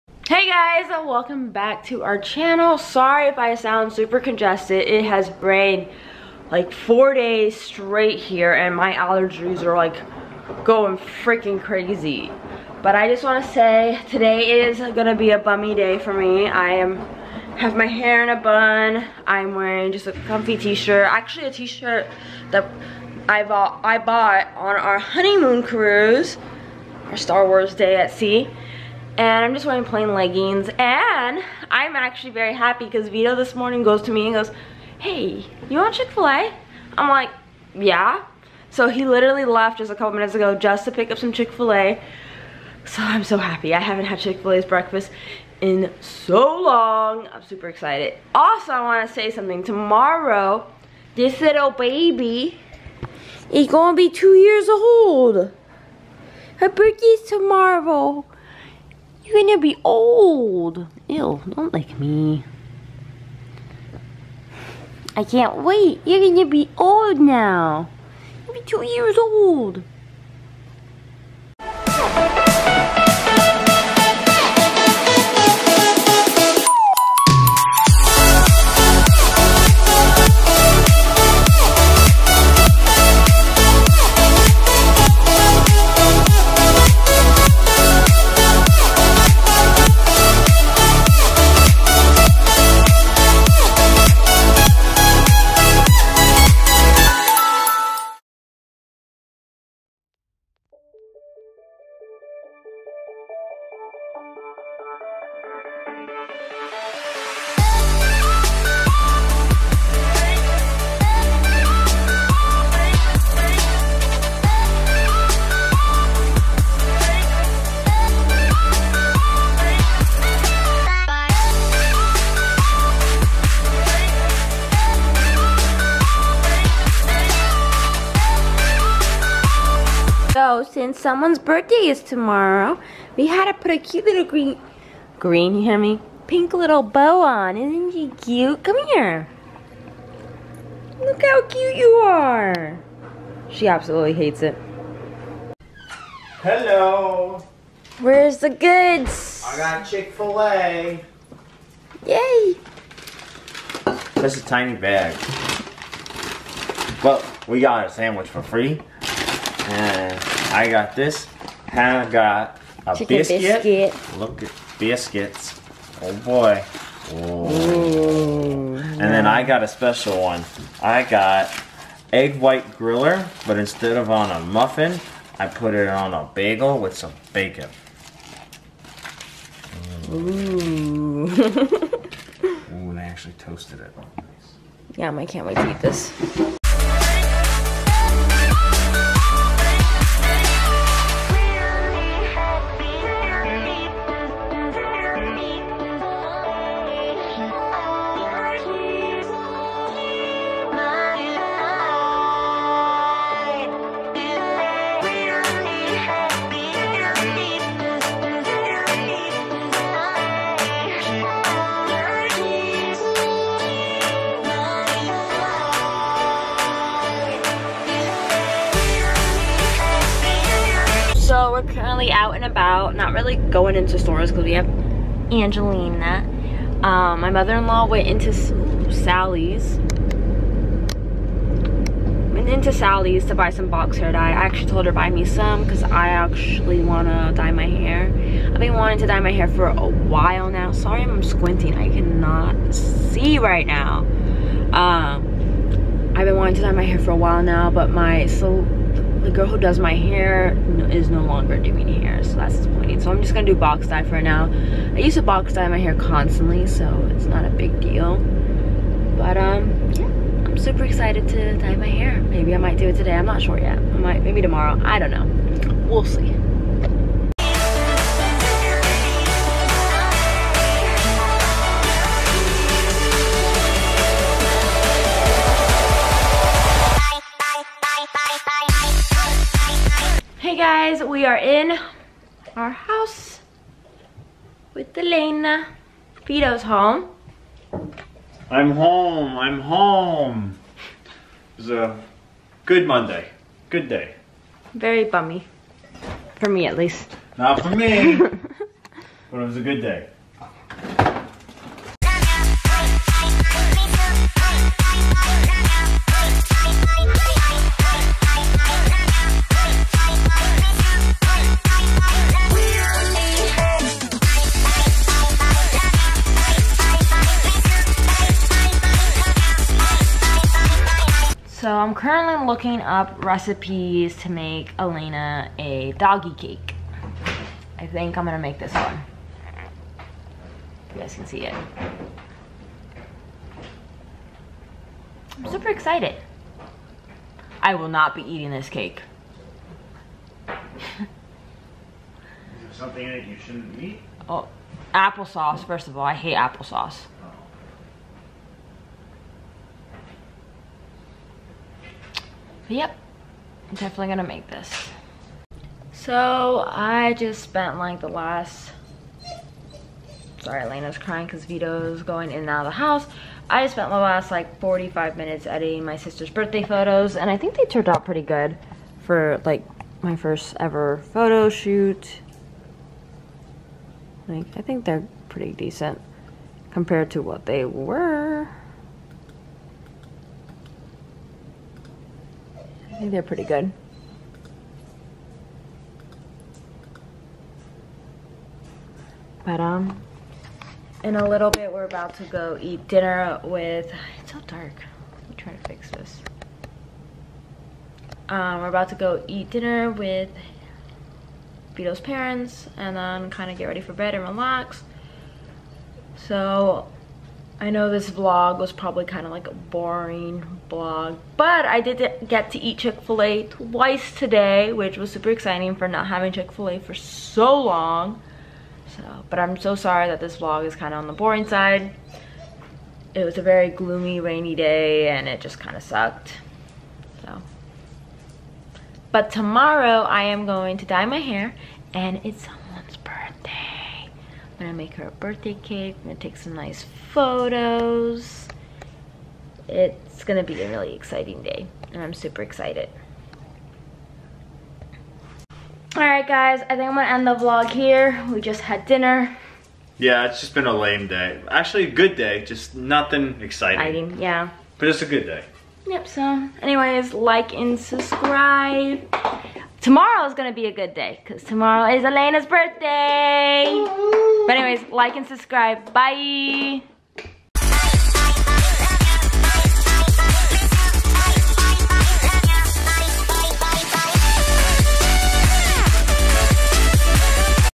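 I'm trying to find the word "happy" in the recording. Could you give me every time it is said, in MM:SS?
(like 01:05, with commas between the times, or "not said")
00:32, 00:43.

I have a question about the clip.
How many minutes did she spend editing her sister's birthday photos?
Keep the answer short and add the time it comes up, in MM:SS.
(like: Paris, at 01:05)
45, at 06:04.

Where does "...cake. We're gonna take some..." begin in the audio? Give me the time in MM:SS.
07:15.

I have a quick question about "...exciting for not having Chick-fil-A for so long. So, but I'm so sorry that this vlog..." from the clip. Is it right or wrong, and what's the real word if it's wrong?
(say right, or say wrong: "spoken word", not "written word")
right.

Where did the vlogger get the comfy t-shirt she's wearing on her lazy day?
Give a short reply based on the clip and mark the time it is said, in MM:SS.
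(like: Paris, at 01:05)
Honeymoon cruise, at 00:24.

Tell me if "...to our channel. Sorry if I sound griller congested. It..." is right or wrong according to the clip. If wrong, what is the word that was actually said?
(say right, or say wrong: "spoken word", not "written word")
wrong: "super", not "griller".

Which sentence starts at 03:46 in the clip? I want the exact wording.
Um, my mother-in-law went into Sally's went into Sally's to buy some box hair dye.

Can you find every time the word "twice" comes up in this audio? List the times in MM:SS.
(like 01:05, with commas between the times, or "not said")
06:53.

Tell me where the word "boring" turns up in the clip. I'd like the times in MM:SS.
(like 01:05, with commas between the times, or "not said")
06:49, 07:01.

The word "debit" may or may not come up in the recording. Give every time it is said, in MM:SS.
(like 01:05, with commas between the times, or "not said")
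not said.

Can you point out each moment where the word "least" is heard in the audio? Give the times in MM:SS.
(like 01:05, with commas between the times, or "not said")
04:56.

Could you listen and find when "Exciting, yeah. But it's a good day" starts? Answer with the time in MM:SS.
07:33.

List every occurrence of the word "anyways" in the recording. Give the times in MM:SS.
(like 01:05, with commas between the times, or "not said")
07:36, 07:44.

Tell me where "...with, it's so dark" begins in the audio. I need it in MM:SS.
06:33.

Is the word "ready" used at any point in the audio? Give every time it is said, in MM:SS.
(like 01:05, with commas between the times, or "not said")
06:43.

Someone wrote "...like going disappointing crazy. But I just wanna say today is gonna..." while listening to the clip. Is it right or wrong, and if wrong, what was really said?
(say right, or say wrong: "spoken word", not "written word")
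wrong: "freaking", not "disappointing".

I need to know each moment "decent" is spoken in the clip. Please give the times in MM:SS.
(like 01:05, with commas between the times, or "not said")
06:15.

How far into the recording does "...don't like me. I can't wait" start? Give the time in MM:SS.
01:01.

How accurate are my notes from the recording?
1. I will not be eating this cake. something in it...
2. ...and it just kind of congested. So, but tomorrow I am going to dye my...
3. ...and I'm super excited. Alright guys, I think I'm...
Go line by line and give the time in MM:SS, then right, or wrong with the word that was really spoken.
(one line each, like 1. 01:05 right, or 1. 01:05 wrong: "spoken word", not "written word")
1. 05:37 right
2. 07:05 wrong: "sucked", not "congested"
3. 07:21 right.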